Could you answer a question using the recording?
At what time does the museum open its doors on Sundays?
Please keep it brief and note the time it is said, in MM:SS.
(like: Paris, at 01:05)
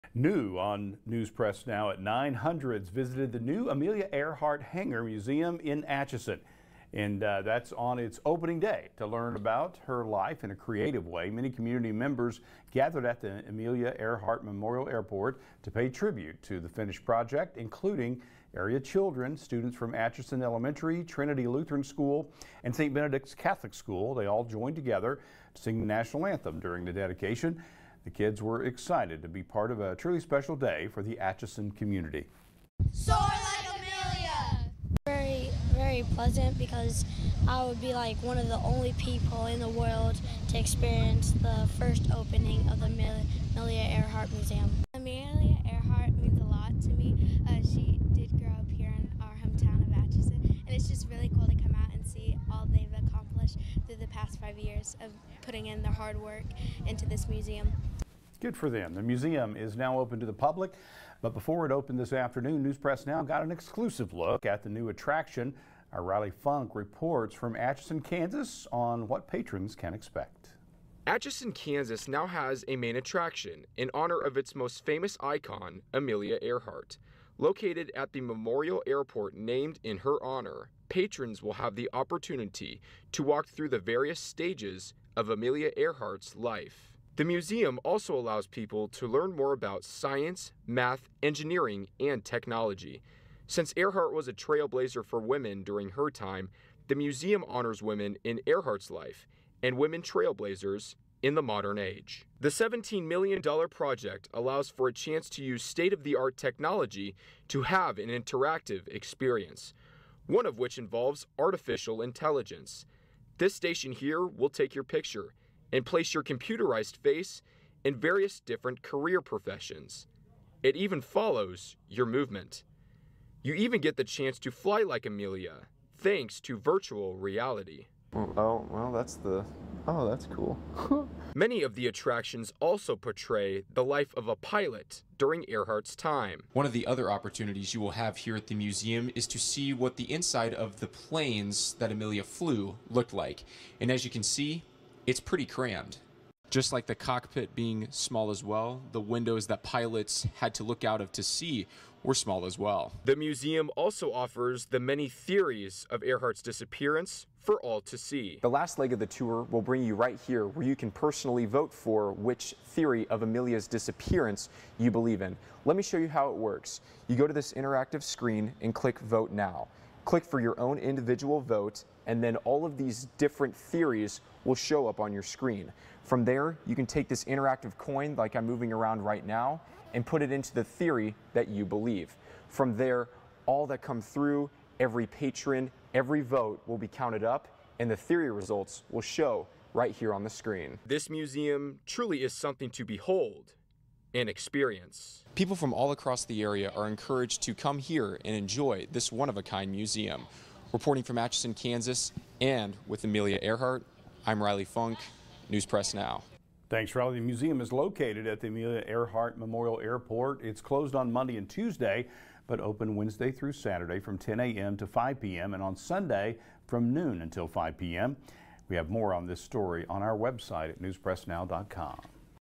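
Noon, at 03:36.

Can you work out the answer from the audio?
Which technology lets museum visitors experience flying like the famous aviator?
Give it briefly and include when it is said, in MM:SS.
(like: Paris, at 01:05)
Virtual reality, at 02:06.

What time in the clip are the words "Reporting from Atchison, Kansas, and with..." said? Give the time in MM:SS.
03:20.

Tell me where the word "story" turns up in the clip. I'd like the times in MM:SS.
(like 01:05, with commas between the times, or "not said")
03:39.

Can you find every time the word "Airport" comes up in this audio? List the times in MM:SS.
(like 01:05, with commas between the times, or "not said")
00:14, 01:18, 03:29.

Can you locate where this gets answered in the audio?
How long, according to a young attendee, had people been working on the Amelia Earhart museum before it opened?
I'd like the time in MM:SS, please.
00:54.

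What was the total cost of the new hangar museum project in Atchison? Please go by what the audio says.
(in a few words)
$17 million.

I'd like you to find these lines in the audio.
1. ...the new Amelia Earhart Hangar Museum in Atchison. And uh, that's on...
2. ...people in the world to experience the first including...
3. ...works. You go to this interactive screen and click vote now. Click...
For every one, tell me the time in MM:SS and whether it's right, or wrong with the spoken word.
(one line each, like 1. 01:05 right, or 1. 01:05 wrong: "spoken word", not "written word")
1. 00:03 right
2. 00:38 wrong: "opening", not "including"
3. 02:46 right.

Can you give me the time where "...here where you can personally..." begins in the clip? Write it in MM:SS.
02:40.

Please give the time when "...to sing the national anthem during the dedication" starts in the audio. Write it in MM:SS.
00:25.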